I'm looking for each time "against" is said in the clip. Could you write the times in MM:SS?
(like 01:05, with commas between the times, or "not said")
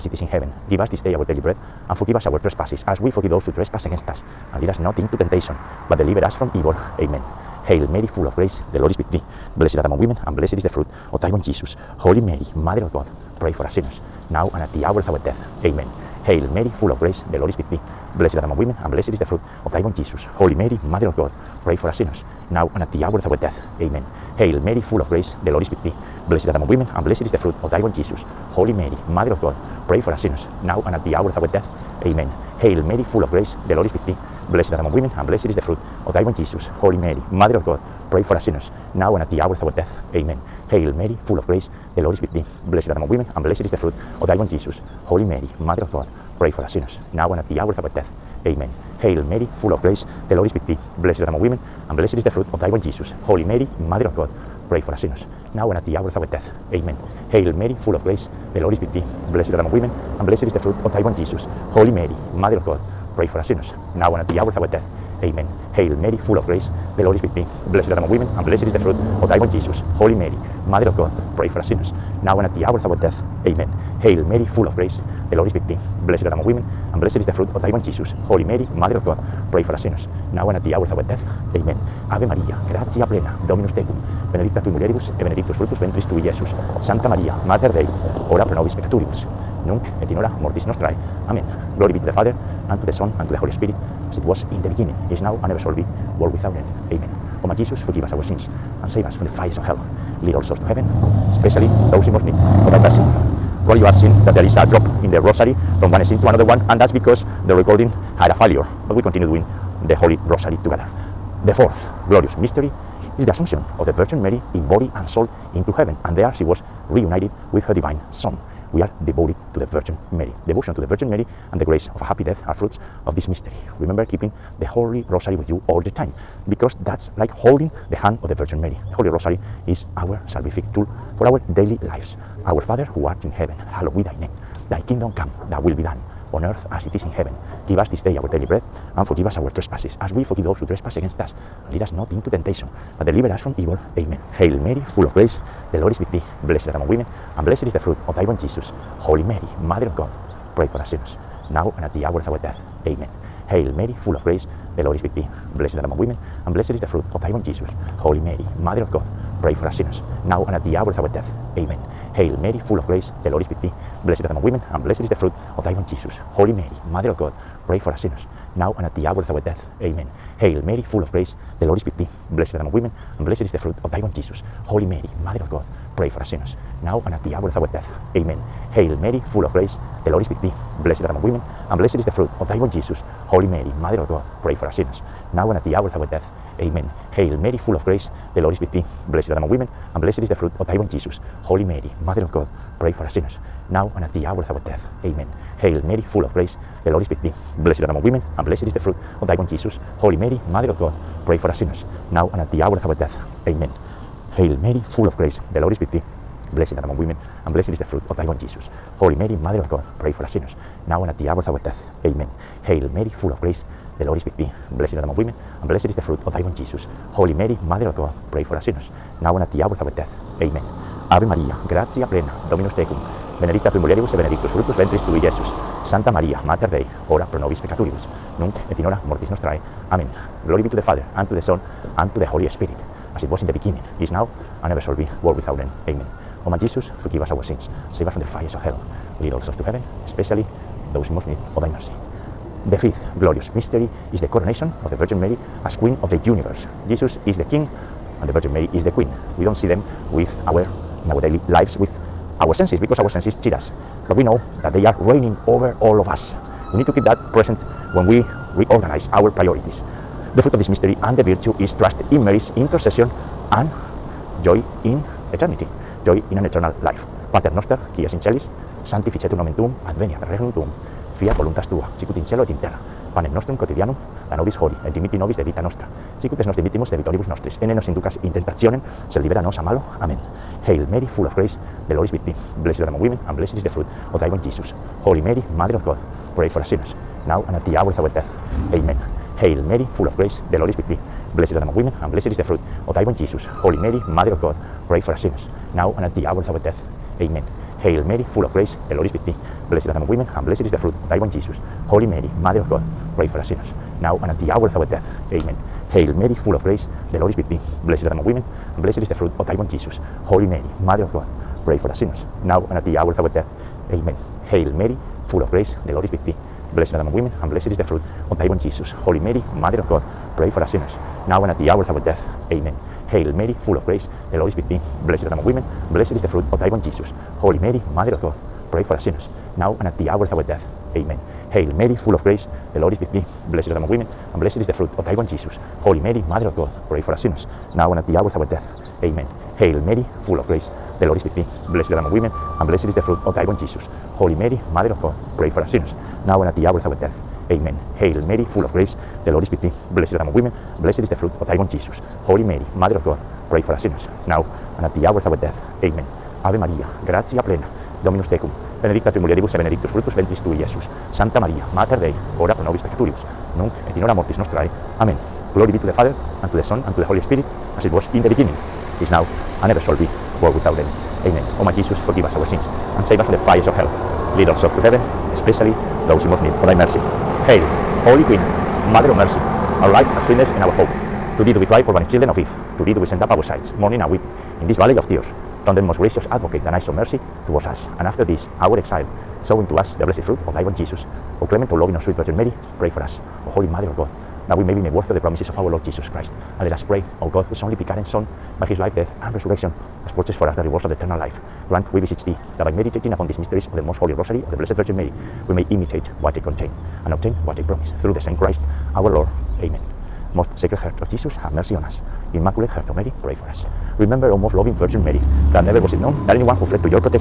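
00:03, 02:20.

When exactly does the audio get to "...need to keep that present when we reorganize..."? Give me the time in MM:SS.
04:16.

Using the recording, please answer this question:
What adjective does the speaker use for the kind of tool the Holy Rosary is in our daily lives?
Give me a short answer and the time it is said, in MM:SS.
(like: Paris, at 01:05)
salvific, at 02:10.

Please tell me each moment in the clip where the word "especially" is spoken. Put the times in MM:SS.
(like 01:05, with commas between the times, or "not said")
01:41, 04:00, 06:15.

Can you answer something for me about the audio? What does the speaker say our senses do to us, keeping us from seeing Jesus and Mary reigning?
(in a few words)
cheat us.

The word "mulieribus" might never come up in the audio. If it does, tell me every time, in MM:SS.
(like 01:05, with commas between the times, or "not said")
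01:24, 03:43, 05:59.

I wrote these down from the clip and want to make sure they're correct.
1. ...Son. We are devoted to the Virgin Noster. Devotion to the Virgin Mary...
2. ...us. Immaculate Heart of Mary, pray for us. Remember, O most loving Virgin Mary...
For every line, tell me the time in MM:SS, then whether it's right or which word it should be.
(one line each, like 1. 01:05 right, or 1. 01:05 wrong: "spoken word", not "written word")
1. 01:58 wrong: "Mary", not "Noster"
2. 06:51 right.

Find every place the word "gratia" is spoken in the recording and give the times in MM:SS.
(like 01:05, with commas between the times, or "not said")
01:22, 03:41, 05:57.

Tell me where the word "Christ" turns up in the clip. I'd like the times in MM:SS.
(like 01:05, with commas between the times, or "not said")
06:36, 06:48.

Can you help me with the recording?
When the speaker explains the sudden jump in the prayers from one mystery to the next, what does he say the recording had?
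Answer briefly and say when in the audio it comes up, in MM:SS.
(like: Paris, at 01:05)
a failure, at 01:48.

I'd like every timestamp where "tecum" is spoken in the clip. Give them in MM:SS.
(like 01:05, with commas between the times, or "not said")
01:23, 03:42, 05:58.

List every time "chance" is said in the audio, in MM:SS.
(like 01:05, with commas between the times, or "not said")
not said.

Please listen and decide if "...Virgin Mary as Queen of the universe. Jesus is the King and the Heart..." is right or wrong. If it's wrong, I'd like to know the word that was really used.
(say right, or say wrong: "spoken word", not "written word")
wrong: "Virgin", not "Heart".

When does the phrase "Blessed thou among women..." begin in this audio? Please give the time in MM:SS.
05:49.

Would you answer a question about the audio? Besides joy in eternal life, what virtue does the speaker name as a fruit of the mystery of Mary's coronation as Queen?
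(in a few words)
trust in Mary's intercession.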